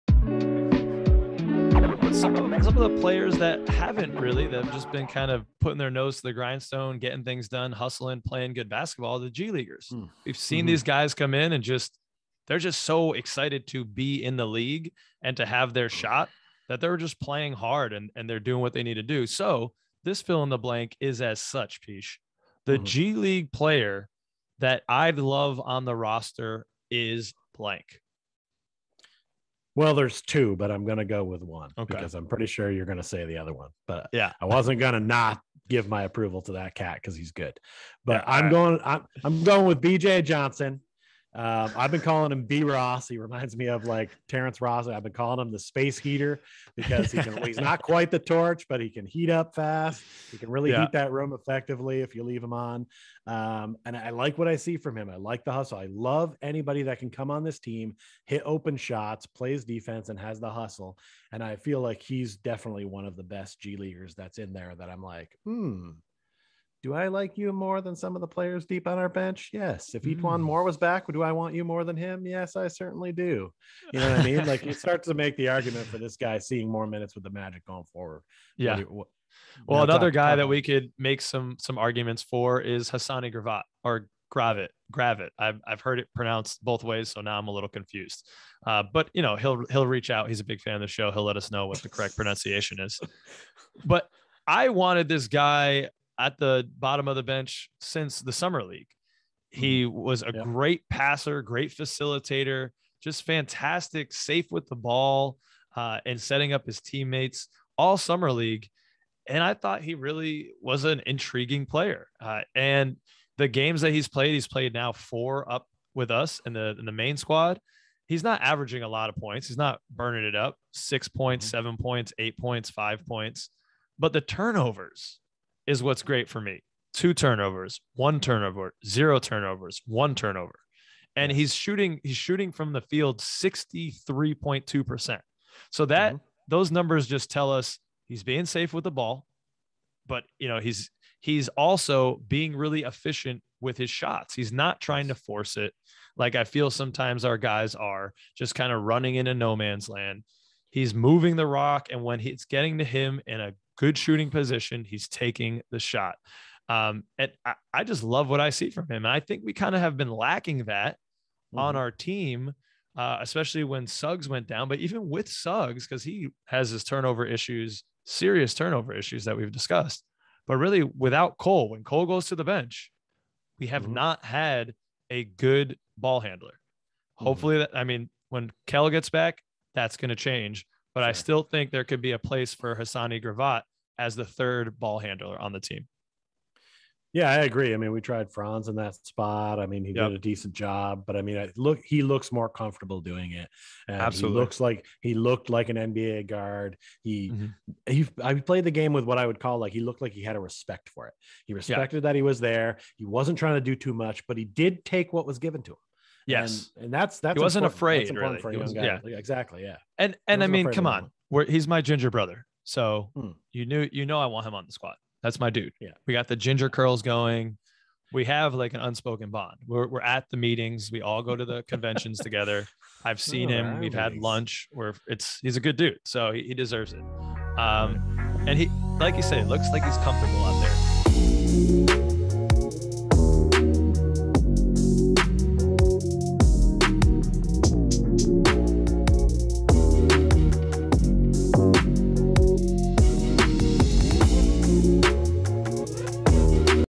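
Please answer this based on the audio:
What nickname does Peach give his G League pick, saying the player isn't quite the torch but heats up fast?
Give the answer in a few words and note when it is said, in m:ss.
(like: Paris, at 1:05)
the space heater, at 0:45.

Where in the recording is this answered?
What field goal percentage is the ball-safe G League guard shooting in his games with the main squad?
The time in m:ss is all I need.
2:13.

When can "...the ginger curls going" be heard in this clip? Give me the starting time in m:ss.
3:36.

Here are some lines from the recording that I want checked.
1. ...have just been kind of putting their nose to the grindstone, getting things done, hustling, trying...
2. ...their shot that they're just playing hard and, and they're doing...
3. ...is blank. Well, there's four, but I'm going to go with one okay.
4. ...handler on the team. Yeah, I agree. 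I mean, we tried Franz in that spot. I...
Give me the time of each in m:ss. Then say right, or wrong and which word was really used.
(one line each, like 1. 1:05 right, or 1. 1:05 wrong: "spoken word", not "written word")
1. 0:04 wrong: "playing", not "trying"
2. 0:15 right
3. 0:26 wrong: "two", not "four"
4. 3:04 right.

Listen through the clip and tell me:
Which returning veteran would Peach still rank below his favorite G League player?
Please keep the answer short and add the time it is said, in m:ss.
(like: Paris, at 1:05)
E'Twaun Moore, at 1:10.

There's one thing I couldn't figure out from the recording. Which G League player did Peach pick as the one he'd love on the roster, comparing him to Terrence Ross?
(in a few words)
B.J. Johnson.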